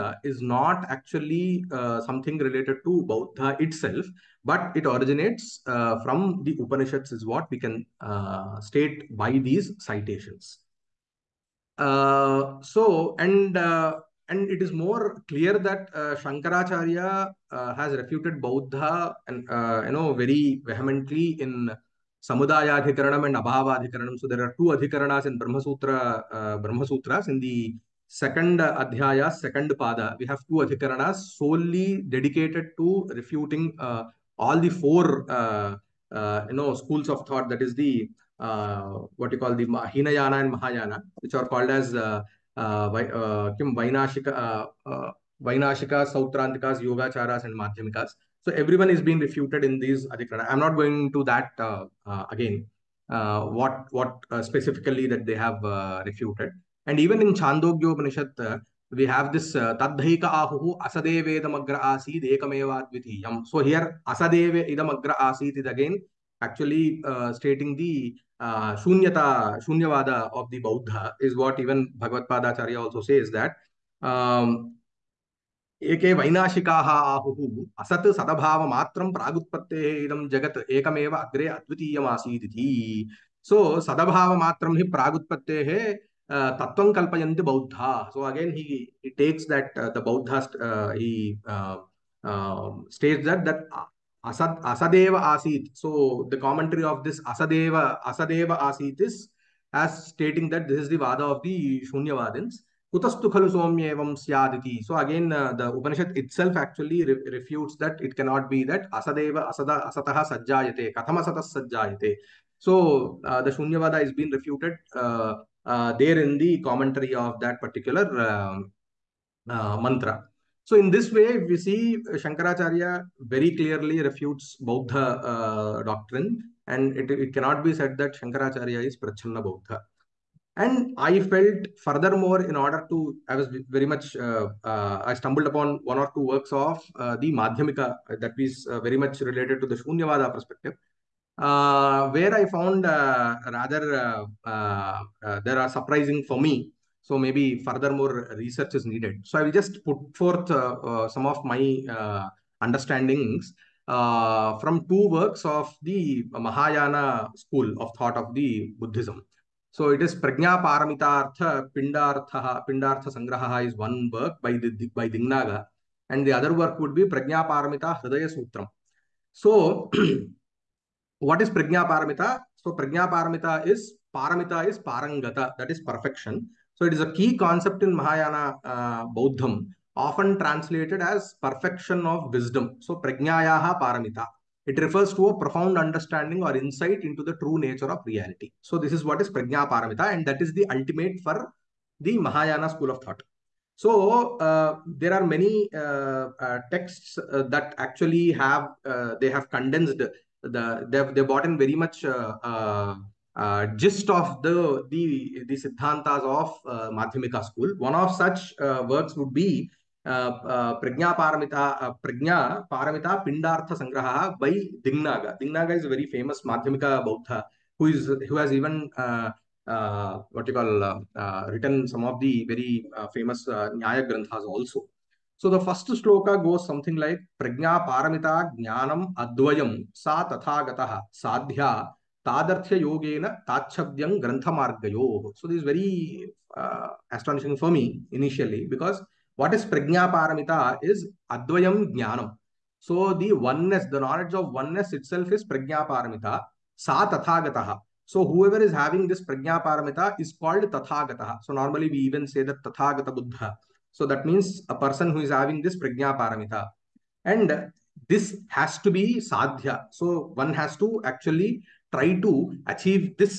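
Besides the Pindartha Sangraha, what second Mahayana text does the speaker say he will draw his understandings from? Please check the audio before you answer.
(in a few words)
Prajna Paramita Hridaya Sutram.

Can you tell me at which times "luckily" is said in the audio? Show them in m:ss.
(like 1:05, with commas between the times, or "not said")
not said.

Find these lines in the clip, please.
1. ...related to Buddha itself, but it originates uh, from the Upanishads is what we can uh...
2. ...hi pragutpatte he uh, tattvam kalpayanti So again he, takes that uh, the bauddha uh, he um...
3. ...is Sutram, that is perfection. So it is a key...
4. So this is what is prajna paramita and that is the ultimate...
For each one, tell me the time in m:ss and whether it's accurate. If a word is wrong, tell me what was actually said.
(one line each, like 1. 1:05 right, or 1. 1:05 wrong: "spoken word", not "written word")
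1. 0:02 right
2. 1:24 right
3. 2:54 wrong: "Parangata", not "Sutram"
4. 3:08 right.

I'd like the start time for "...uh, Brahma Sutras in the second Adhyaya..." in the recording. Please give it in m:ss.
0:26.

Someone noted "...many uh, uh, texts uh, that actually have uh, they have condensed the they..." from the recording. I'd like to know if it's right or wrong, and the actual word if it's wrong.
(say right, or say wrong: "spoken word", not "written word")
right.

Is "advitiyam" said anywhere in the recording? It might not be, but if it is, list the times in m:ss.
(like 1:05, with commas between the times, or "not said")
1:02, 1:21.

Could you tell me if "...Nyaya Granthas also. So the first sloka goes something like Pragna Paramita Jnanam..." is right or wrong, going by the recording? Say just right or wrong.
right.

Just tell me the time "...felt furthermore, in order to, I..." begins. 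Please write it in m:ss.
2:11.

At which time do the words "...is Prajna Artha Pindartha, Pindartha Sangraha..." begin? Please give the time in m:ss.
2:40.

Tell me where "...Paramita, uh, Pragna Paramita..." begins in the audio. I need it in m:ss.
3:31.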